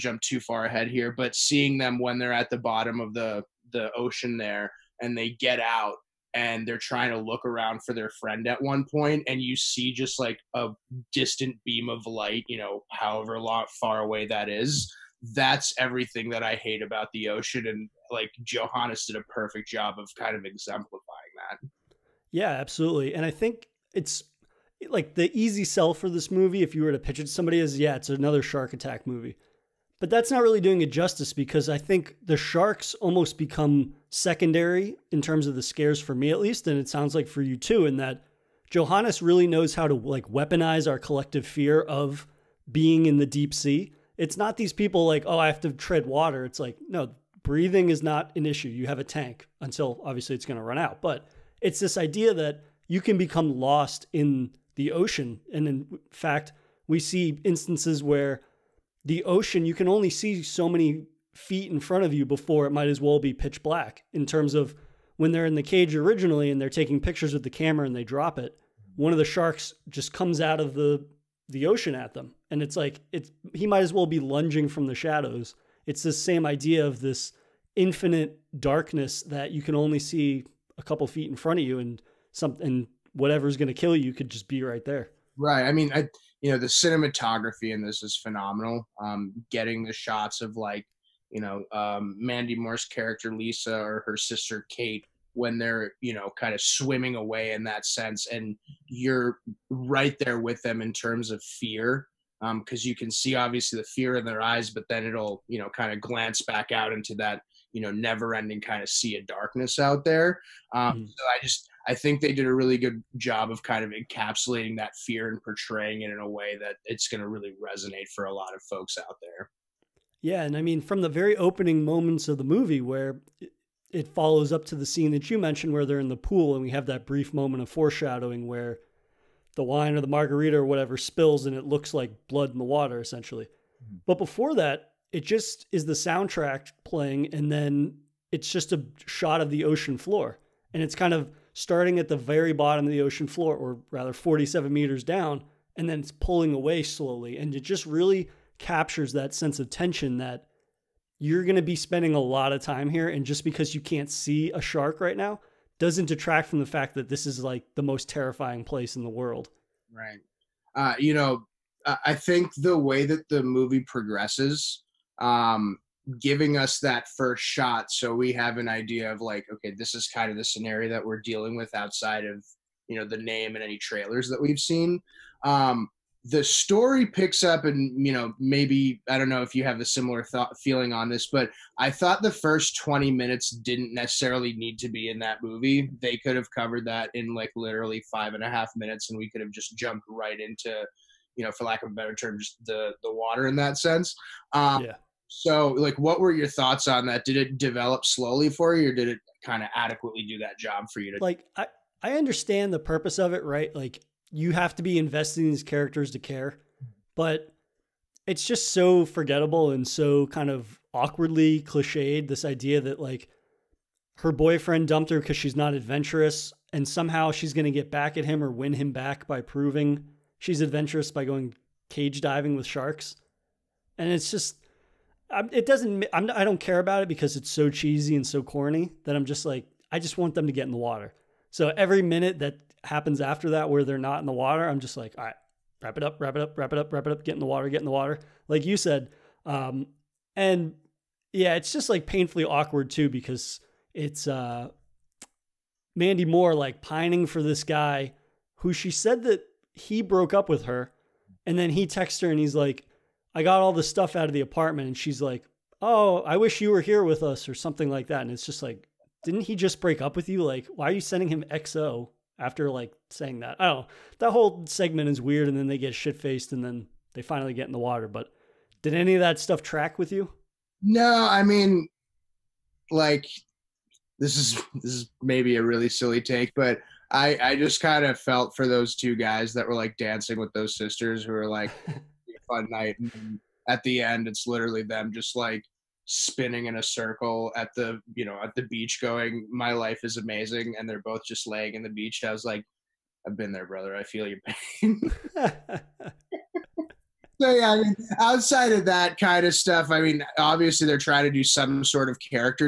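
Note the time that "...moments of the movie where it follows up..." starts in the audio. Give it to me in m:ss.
2:01.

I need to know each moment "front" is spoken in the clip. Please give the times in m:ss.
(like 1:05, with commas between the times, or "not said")
1:01, 1:21.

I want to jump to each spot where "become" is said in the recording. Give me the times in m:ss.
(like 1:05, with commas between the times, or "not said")
0:33, 0:53.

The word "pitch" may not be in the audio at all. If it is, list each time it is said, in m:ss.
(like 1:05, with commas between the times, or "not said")
0:26, 1:03.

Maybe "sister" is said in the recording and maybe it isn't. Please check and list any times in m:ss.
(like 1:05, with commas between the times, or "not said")
1:34, 4:40.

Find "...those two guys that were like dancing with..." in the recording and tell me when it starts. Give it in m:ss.
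4:38.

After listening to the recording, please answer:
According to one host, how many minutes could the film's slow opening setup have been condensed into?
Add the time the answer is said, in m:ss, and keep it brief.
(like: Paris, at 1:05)
5 and a half minutes, at 3:08.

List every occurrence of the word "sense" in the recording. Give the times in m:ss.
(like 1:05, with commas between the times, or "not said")
1:37, 2:29, 3:13.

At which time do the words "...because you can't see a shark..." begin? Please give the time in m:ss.
2:33.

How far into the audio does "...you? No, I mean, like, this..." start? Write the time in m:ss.
4:30.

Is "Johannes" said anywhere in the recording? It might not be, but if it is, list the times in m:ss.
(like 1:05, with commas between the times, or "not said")
0:18, 0:38.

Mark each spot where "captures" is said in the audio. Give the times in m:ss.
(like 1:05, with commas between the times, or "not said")
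2:28.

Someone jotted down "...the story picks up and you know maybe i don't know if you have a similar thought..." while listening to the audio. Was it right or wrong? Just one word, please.
right.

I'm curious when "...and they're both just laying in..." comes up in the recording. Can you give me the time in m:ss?
4:50.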